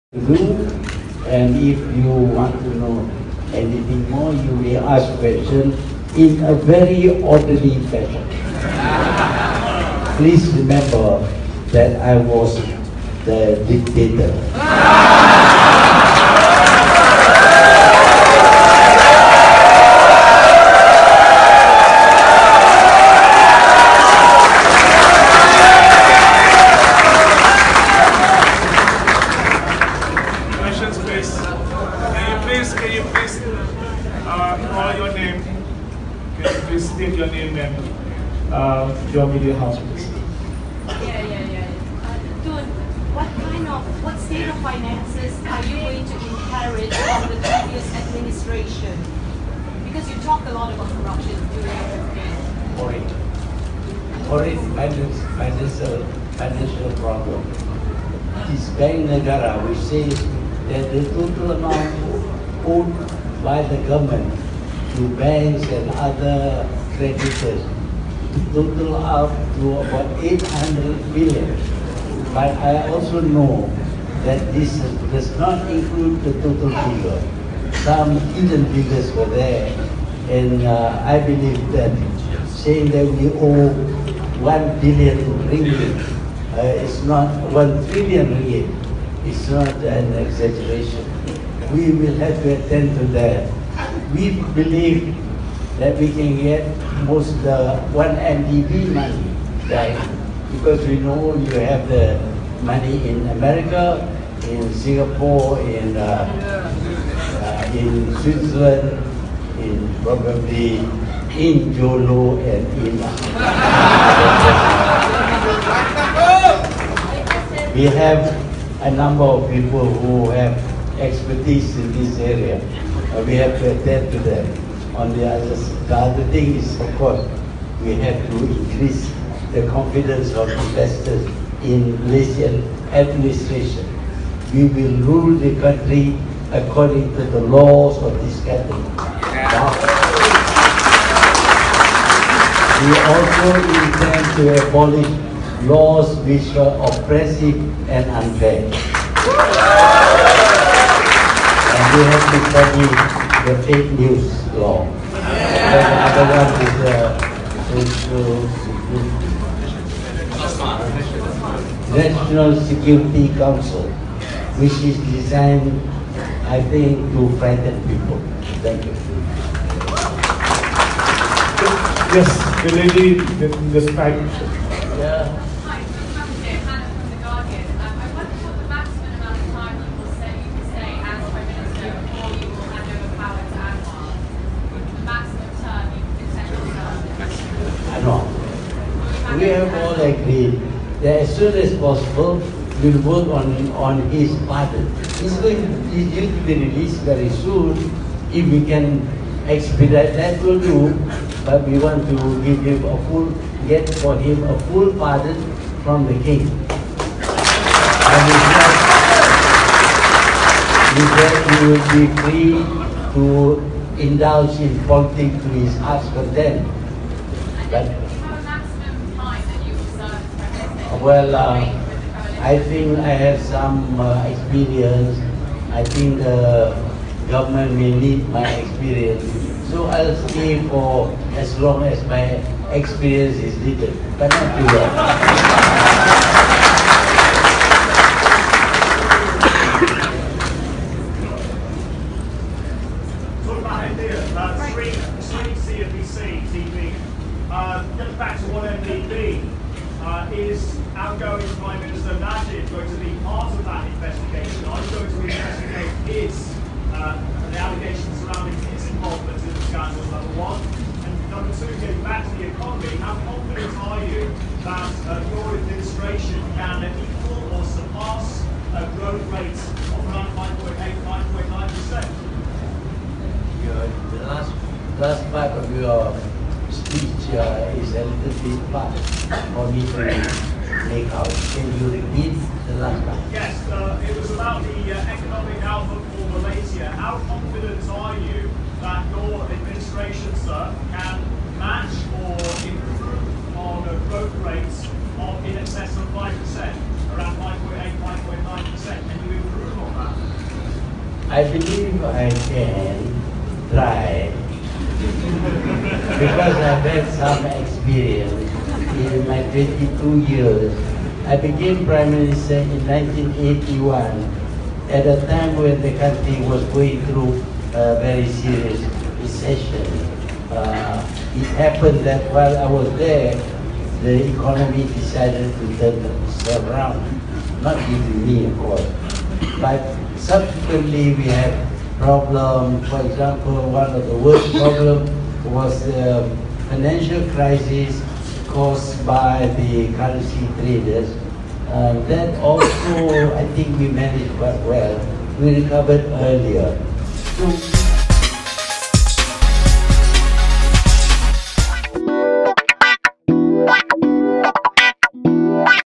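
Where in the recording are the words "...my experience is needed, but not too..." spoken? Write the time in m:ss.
3:52.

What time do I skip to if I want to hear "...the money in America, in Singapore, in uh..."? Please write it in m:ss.
1:41.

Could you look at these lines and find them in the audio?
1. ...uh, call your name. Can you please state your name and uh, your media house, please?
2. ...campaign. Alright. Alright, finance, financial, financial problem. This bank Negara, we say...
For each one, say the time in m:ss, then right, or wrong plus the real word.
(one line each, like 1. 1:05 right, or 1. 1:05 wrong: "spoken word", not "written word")
1. 0:33 right
2. 0:51 right.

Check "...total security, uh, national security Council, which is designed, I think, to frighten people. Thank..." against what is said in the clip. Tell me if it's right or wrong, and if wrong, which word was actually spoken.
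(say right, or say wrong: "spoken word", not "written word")
wrong: "national", not "total".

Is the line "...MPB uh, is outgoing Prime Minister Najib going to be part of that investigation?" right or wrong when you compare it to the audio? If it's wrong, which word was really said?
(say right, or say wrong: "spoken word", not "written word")
right.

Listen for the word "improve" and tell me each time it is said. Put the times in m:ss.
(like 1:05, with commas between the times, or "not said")
4:52, 4:59.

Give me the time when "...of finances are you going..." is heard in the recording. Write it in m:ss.
0:44.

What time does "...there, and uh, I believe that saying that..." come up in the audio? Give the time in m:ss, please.
1:19.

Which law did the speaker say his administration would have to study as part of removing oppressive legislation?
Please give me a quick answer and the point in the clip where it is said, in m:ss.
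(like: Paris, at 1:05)
fake news law, at 2:33.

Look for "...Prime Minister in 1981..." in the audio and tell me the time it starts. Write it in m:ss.
5:11.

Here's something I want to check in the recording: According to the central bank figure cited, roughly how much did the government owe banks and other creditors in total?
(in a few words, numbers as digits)
800 billion.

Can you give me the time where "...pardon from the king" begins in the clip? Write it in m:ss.
3:24.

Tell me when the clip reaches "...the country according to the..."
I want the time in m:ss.
2:15.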